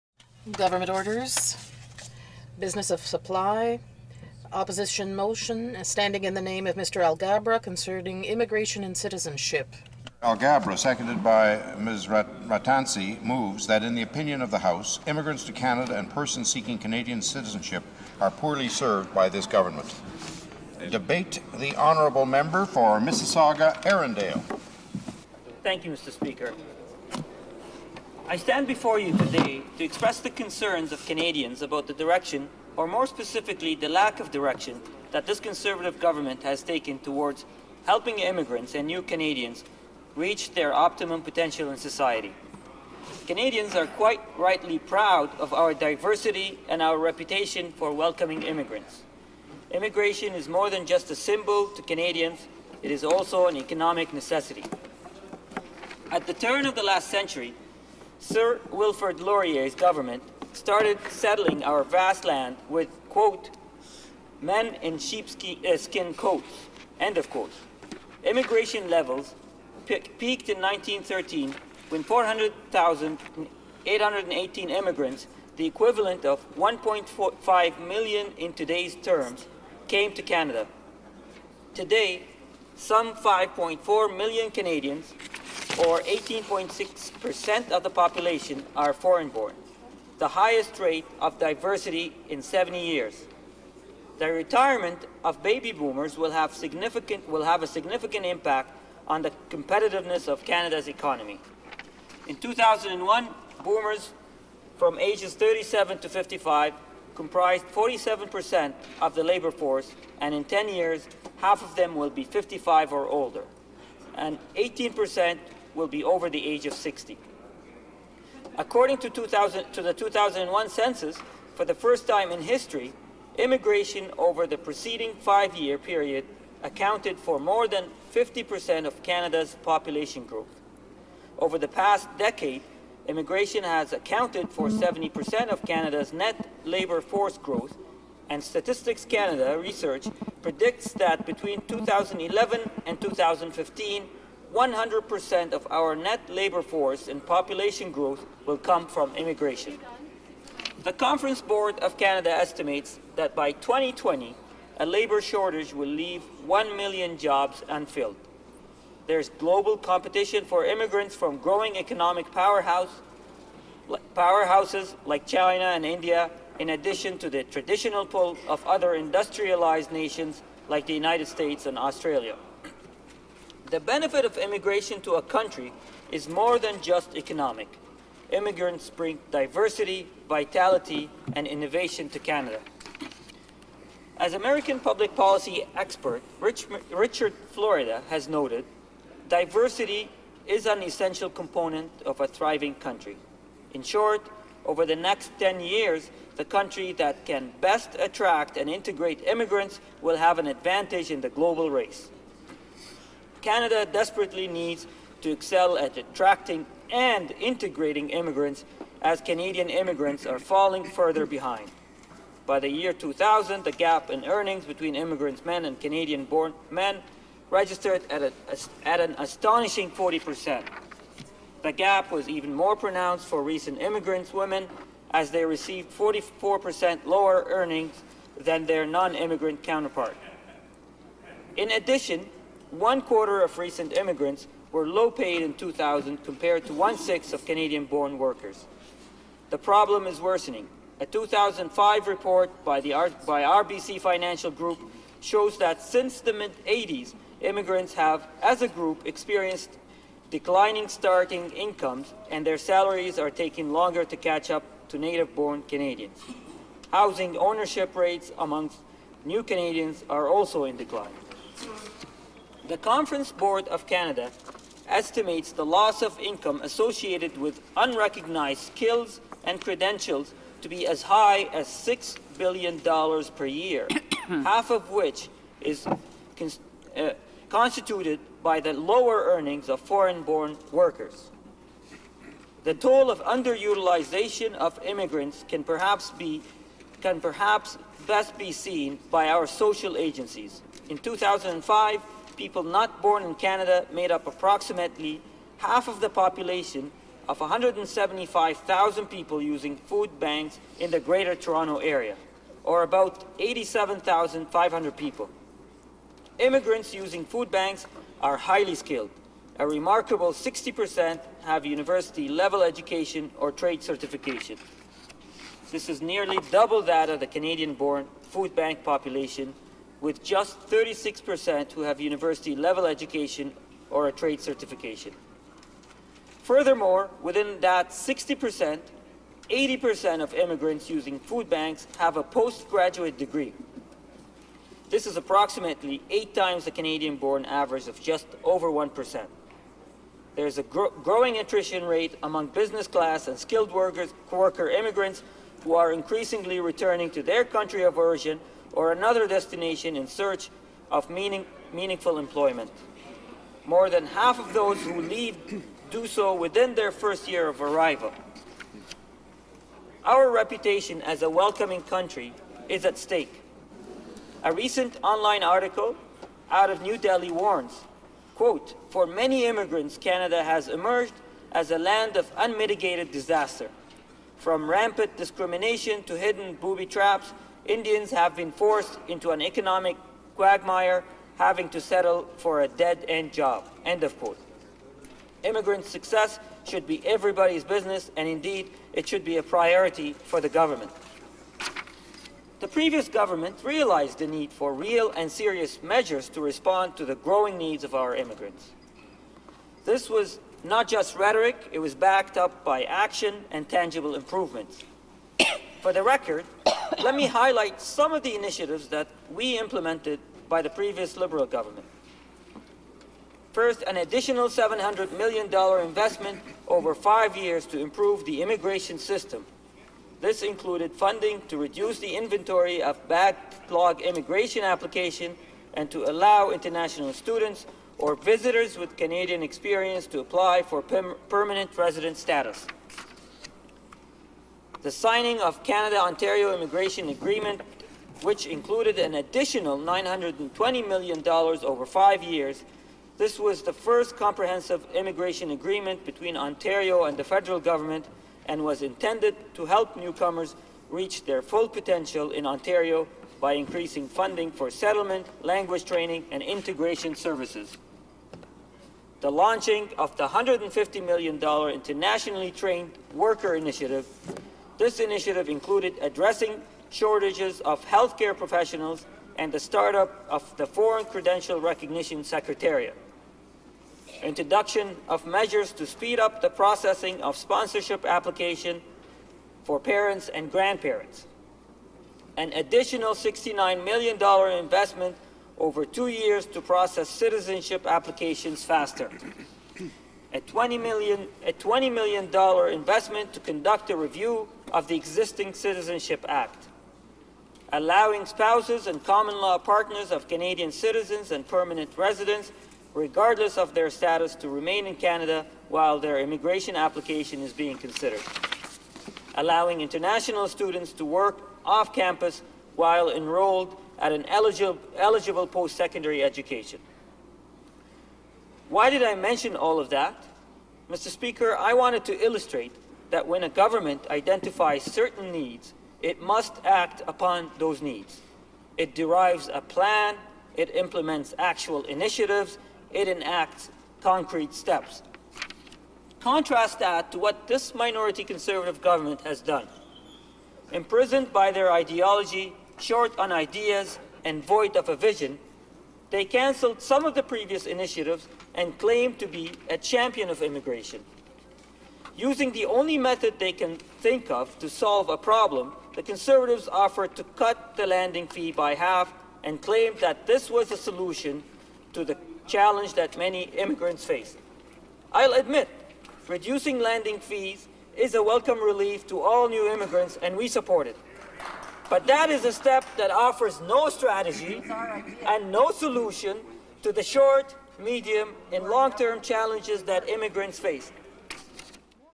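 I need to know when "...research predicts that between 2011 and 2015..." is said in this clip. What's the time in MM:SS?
02:19.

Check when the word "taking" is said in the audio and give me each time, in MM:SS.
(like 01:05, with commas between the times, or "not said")
04:13.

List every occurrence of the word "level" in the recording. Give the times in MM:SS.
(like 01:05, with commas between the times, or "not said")
01:08, 05:12, 05:22.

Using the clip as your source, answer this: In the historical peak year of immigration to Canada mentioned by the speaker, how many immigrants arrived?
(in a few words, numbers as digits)
400,818.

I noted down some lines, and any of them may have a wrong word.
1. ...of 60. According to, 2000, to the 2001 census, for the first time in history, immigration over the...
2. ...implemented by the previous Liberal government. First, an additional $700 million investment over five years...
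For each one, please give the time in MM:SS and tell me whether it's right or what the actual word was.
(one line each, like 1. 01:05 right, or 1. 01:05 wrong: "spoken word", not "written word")
1. 01:56 right
2. 06:49 right.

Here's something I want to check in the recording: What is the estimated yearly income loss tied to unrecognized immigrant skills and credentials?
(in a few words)
$6 billion.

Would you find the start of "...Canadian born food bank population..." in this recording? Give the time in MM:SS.
05:17.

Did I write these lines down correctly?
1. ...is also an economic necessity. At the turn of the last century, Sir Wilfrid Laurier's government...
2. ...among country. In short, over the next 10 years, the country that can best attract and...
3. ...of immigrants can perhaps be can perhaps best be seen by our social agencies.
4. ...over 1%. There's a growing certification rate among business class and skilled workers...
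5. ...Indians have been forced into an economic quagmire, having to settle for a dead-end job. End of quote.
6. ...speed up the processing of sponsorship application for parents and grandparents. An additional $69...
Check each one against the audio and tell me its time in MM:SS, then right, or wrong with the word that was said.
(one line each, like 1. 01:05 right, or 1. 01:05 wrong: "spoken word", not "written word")
1. 00:52 right
2. 03:12 wrong: "thriving", not "among"
3. 04:44 right
4. 05:38 wrong: "attrition", not "certification"
5. 06:17 right
6. 07:55 right.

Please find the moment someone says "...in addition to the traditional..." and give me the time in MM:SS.
02:46.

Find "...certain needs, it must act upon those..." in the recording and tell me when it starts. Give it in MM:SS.
08:44.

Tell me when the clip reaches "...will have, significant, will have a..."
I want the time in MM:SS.
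01:36.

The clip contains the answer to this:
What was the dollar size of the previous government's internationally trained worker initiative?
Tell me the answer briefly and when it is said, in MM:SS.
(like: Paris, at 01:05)
$150 million, at 07:40.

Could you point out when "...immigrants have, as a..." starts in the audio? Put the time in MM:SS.
04:07.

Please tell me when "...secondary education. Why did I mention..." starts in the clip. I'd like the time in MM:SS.
08:35.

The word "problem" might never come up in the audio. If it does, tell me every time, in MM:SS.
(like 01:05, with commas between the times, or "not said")
03:59, 09:15.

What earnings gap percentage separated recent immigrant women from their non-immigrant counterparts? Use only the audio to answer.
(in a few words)
44%.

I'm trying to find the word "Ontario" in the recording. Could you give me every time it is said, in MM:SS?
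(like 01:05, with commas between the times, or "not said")
07:15, 07:26, 07:32.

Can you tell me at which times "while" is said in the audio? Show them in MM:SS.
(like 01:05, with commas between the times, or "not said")
08:25, 08:32.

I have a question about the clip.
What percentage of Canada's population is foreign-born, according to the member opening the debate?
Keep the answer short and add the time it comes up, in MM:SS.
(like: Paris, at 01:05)
18.6%, at 01:26.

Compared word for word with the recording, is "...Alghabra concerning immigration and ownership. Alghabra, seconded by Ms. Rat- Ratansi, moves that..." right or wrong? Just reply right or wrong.
wrong.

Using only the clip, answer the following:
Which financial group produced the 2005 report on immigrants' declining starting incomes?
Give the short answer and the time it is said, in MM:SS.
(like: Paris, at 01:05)
RBC Financial Group, at 04:03.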